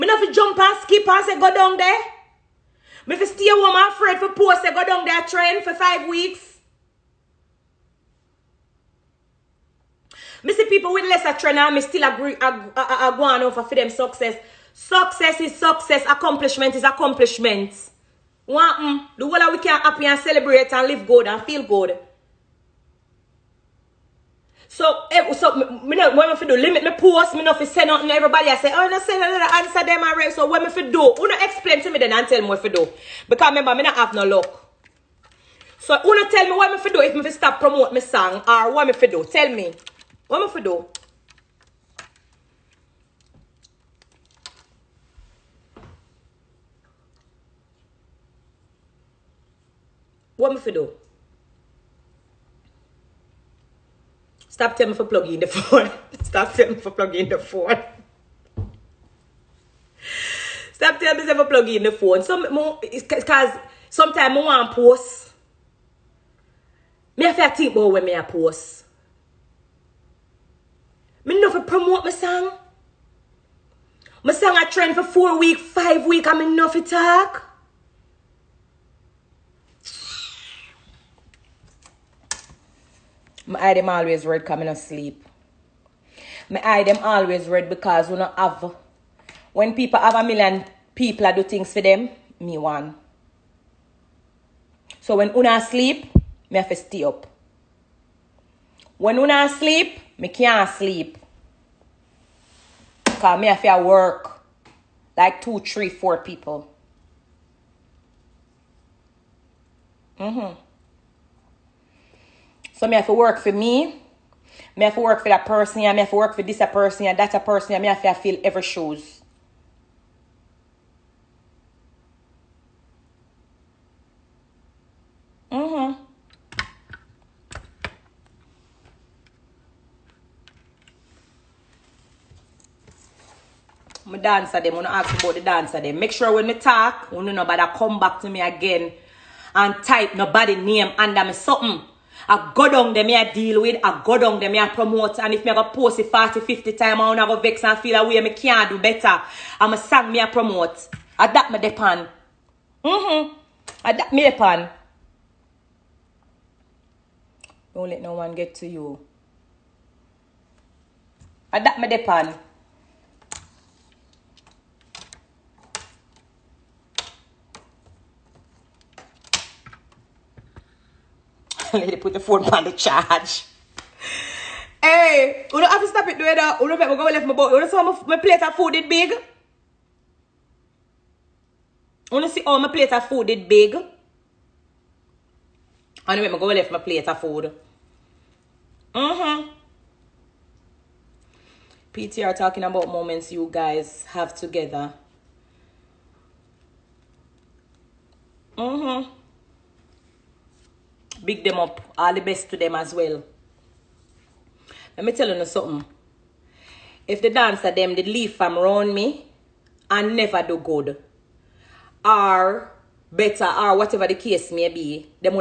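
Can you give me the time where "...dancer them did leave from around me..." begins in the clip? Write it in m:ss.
3:27.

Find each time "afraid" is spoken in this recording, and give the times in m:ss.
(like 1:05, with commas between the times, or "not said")
0:03.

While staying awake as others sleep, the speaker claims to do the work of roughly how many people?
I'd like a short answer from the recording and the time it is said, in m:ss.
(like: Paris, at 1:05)
2, 3, 4, at 1:45.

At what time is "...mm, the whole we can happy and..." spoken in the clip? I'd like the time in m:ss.
0:18.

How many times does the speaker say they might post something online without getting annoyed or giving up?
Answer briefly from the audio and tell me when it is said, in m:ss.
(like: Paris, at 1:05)
40, 50, at 2:26.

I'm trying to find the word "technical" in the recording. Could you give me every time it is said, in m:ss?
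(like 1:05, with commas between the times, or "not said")
not said.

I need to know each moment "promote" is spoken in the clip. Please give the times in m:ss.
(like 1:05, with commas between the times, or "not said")
0:37, 1:11, 2:24, 2:30.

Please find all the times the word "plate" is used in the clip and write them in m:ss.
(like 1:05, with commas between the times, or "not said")
2:58, 3:02, 3:06.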